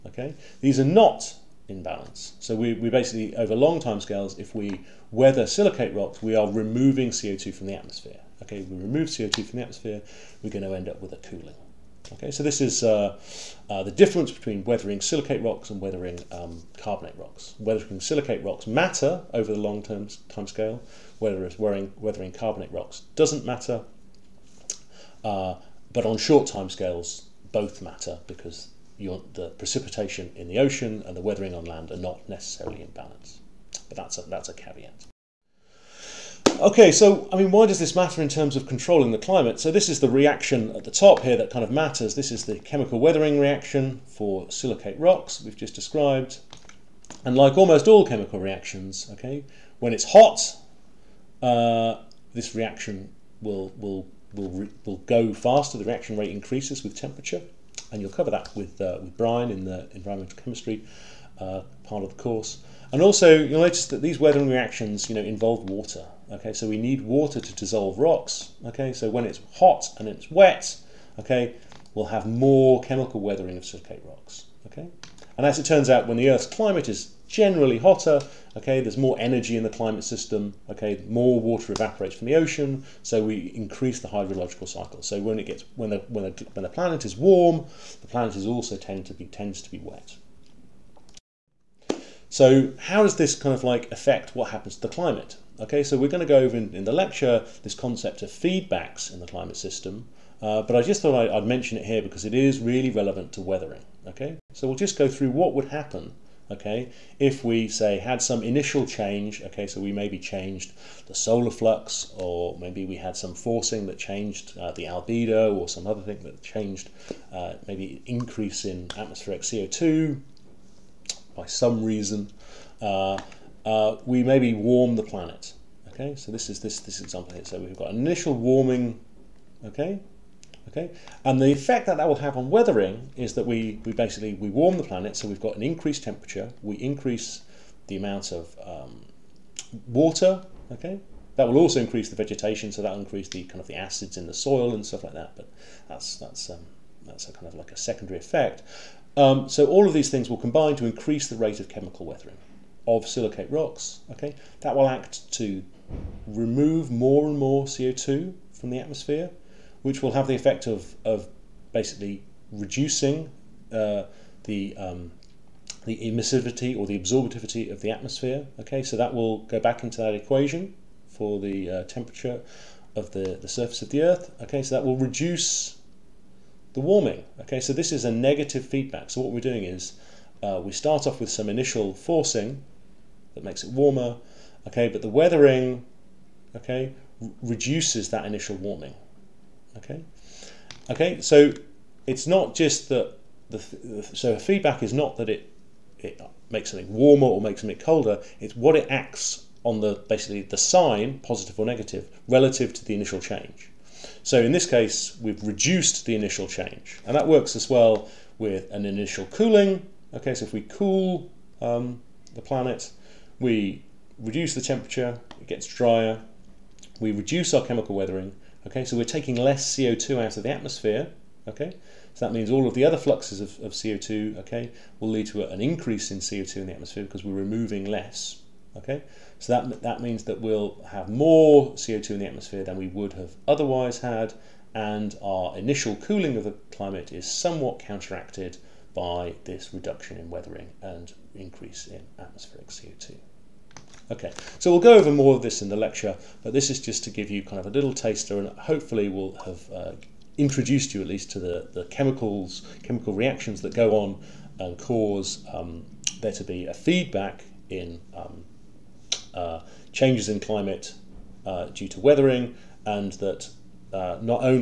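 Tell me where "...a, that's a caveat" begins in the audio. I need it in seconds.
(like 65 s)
34 s.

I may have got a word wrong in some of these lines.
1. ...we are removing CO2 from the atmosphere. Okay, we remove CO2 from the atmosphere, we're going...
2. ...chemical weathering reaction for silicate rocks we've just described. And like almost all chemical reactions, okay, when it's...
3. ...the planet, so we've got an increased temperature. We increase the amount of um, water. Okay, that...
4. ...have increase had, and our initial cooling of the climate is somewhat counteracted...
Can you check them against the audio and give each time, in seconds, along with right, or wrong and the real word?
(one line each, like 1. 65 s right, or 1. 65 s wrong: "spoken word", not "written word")
1. 6 s right
2. 42 s right
3. 134 s right
4. 233 s wrong: "otherwise", not "increase".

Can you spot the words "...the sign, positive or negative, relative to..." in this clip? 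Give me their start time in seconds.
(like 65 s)
200 s.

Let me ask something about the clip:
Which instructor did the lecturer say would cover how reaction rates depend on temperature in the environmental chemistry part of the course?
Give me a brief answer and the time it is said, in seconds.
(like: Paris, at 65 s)
Brian, at 59 s.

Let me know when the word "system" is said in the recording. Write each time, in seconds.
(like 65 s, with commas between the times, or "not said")
80 s, 99 s.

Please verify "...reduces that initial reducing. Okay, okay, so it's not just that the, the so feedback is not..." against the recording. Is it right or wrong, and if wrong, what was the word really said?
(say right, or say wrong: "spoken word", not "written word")
wrong: "warming", not "reducing".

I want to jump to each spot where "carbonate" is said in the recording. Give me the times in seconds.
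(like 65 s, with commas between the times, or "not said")
16 s, 22 s.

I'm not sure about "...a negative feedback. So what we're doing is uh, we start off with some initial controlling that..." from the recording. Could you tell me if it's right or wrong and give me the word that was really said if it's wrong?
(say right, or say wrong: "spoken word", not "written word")
wrong: "forcing", not "controlling".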